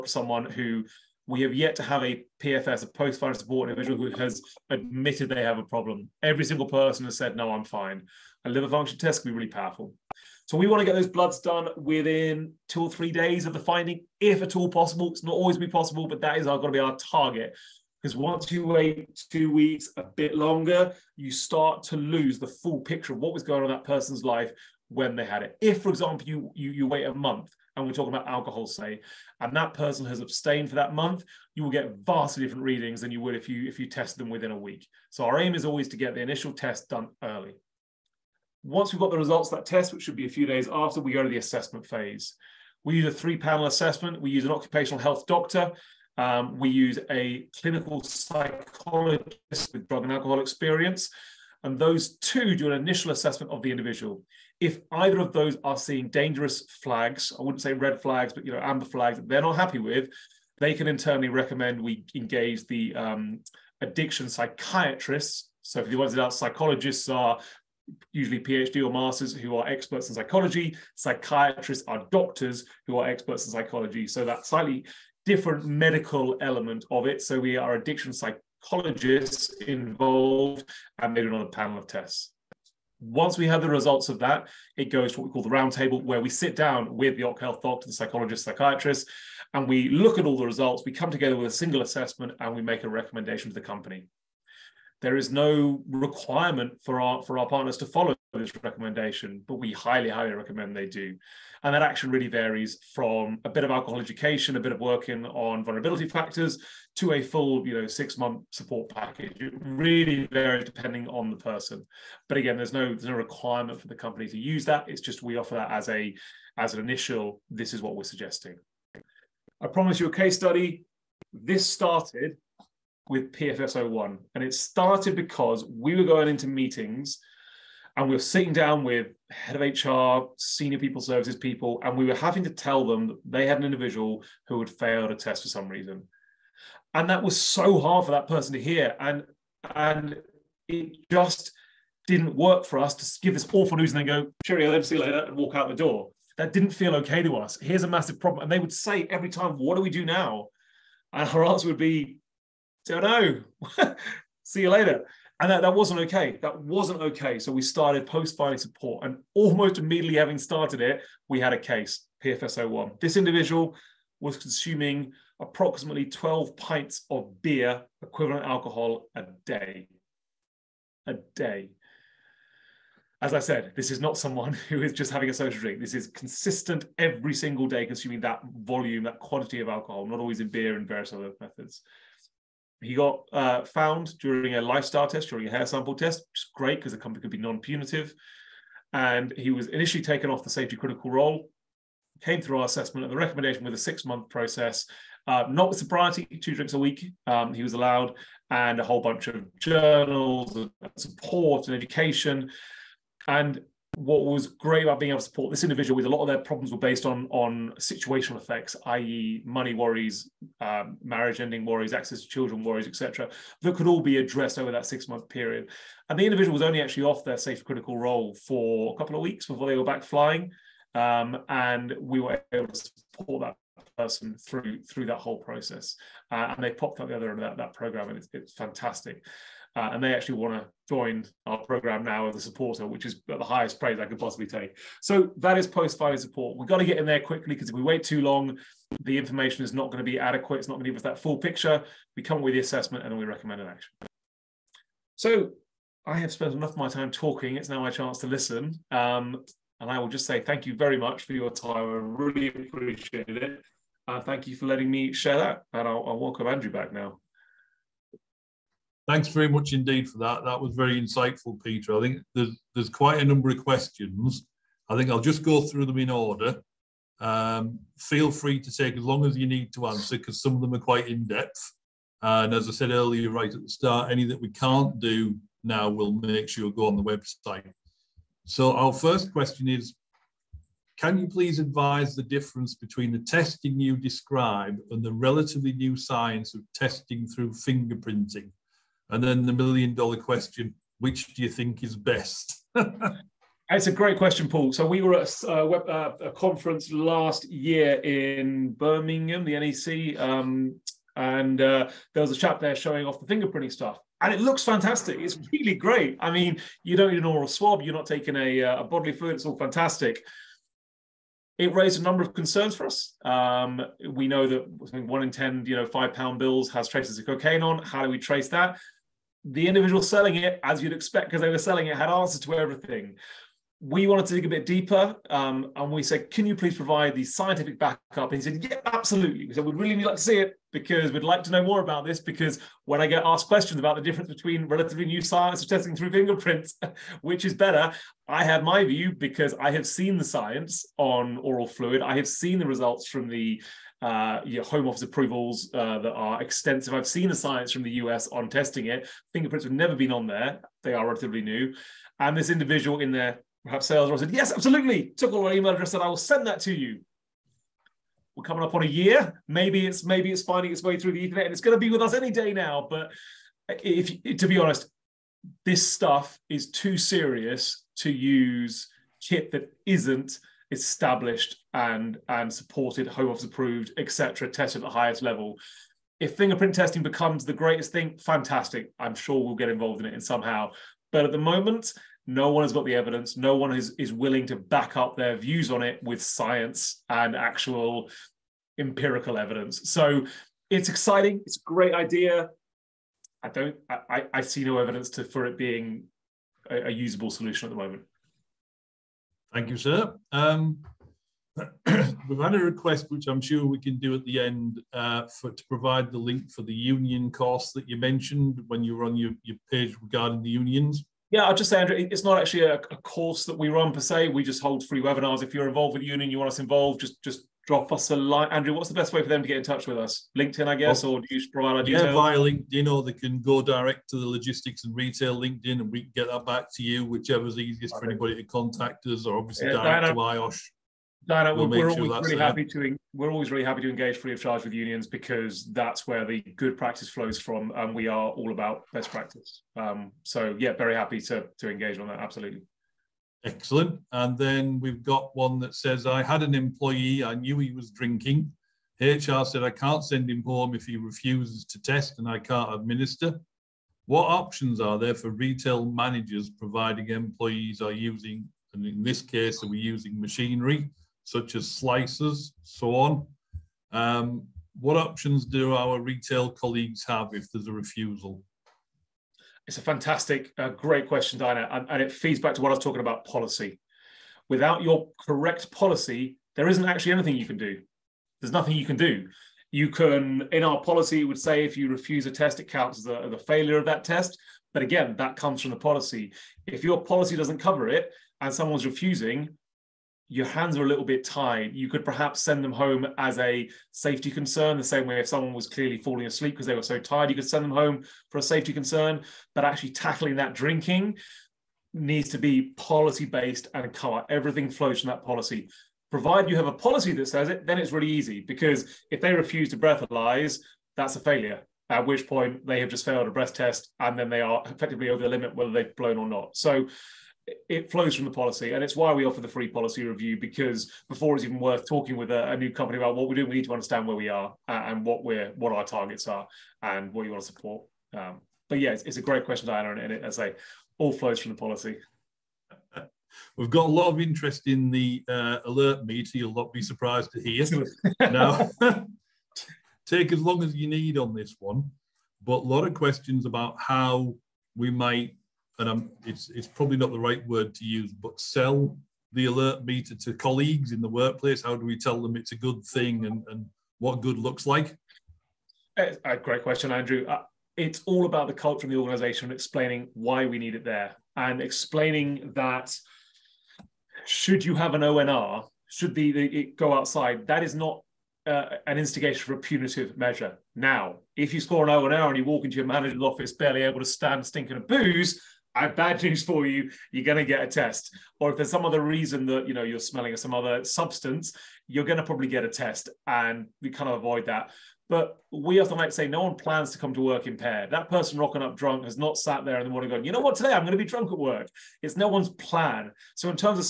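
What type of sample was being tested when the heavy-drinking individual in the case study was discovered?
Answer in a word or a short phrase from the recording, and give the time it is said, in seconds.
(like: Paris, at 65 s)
Hair sample, at 185 s.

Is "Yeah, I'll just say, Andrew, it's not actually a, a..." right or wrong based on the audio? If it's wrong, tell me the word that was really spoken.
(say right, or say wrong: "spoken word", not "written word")
right.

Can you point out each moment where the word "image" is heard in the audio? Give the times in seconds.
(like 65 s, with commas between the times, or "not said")
not said.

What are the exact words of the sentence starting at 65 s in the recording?
So for the ones that are psychologists are usually PhD or masters who are experts in psychology.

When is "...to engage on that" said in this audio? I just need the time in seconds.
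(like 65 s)
441 s.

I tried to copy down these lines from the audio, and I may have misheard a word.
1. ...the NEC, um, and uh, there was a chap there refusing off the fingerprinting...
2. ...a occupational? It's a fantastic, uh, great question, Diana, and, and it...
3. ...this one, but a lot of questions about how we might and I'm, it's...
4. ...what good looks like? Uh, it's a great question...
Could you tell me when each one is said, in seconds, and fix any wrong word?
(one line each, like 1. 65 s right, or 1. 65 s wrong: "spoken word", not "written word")
1. 299 s wrong: "showing", not "refusing"
2. 467 s wrong: "refusal", not "occupational"
3. 541 s right
4. 553 s right.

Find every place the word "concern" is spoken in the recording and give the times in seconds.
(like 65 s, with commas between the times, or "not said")
312 s, 494 s, 498 s.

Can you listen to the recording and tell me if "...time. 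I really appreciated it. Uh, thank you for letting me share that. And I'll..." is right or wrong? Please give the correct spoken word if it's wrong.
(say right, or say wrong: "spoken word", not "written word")
right.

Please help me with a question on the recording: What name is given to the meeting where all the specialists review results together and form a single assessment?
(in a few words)
The roundtable.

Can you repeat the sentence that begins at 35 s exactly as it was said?
So our aim is always to get the initial test done early.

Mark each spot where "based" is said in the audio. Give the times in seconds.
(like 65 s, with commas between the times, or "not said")
206 s, 503 s.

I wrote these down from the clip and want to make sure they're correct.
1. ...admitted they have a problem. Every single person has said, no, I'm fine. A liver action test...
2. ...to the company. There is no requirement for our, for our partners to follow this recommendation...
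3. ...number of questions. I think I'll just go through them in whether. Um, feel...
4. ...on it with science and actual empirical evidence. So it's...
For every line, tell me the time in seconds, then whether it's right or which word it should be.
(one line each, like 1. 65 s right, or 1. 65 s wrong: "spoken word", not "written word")
1. 4 s wrong: "function", not "action"
2. 93 s right
3. 263 s wrong: "order", not "whether"
4. 385 s right.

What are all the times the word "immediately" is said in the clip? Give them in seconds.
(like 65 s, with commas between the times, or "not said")
159 s.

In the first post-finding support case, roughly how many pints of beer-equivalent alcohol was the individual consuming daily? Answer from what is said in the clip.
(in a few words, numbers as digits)
12.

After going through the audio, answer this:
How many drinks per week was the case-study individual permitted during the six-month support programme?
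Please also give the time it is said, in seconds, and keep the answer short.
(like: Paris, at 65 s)
2, at 196 s.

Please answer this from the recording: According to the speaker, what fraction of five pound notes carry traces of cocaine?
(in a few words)
1 in 10.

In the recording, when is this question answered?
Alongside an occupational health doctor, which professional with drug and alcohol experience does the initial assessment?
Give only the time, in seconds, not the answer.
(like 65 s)
47 s.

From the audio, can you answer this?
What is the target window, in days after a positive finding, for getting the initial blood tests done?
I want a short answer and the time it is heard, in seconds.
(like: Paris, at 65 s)
2 or 3 days, at 12 s.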